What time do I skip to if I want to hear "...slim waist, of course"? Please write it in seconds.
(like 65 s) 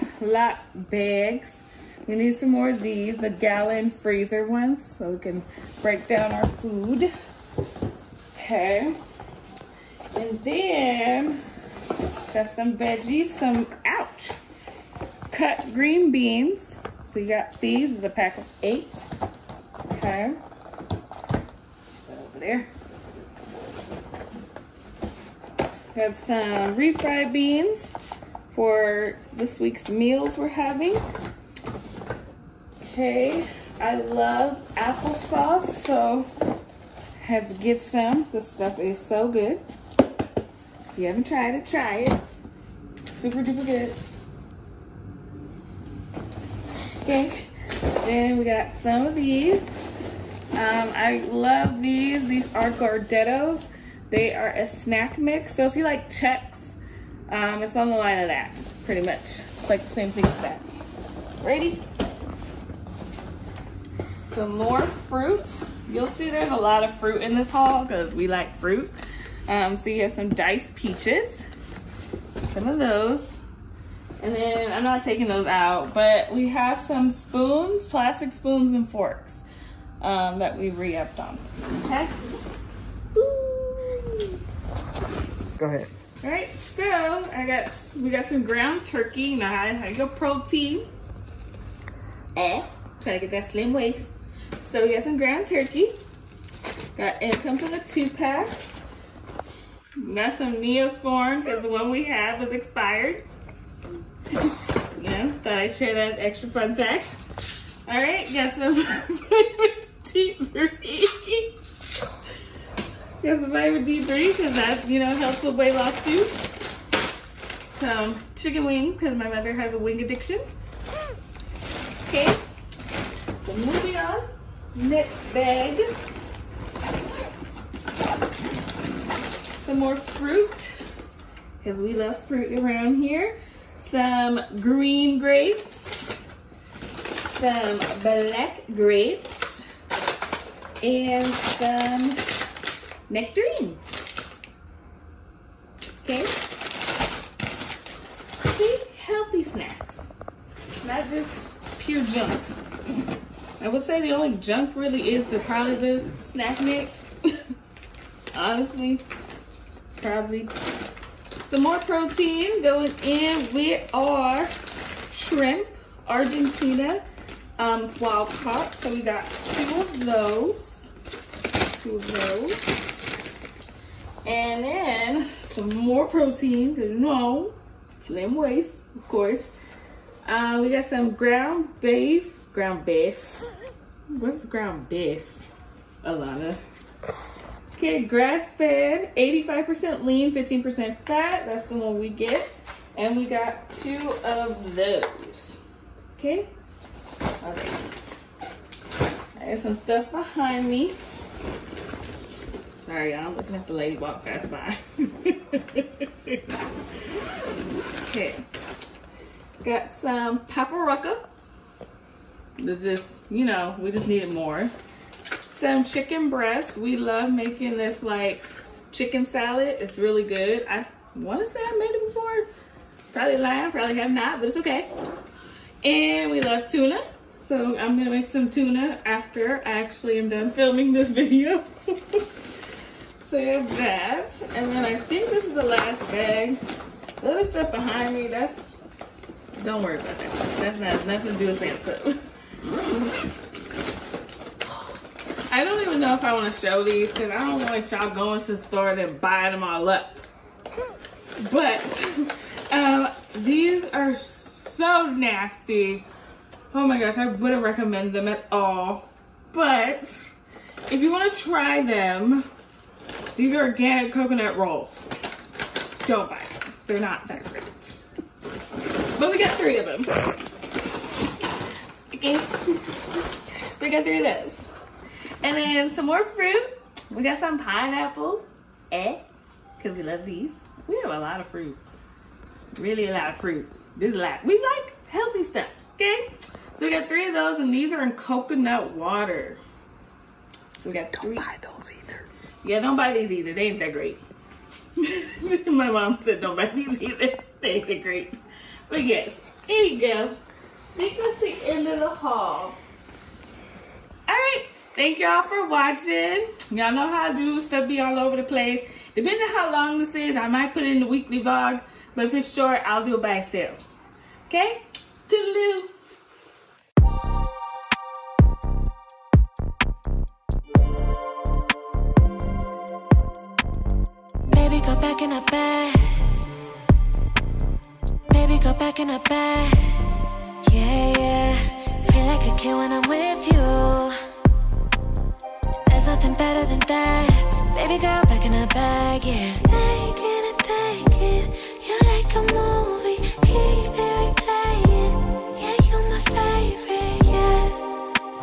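178 s.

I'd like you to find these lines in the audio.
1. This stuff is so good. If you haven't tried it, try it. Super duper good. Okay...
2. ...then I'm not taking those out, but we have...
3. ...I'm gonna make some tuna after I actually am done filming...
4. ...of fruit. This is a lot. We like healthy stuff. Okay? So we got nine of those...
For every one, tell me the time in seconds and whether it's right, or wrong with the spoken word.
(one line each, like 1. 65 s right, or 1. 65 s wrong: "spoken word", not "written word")
1. 38 s right
2. 74 s right
3. 227 s right
4. 283 s wrong: "three", not "nine".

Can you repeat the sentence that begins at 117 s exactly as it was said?
Some chicken wings, because my mother has a wing addiction.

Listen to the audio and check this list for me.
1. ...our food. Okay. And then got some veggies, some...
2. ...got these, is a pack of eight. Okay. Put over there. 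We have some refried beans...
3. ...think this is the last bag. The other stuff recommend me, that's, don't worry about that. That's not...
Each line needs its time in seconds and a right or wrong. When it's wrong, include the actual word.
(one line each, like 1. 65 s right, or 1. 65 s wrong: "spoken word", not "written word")
1. 6 s right
2. 17 s right
3. 235 s wrong: "behind", not "recommend".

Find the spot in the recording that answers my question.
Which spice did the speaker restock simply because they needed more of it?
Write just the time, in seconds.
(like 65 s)
210 s.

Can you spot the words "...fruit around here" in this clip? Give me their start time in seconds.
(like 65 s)
132 s.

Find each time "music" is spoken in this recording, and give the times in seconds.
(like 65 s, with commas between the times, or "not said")
not said.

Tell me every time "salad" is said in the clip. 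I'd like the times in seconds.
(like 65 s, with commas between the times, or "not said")
219 s.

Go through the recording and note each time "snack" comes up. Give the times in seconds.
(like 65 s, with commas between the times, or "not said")
54 s, 149 s, 156 s.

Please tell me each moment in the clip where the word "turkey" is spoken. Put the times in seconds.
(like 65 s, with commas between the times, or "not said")
88 s, 95 s.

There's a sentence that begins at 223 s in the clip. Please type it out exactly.
Probably lying, probably have not, but it's okay.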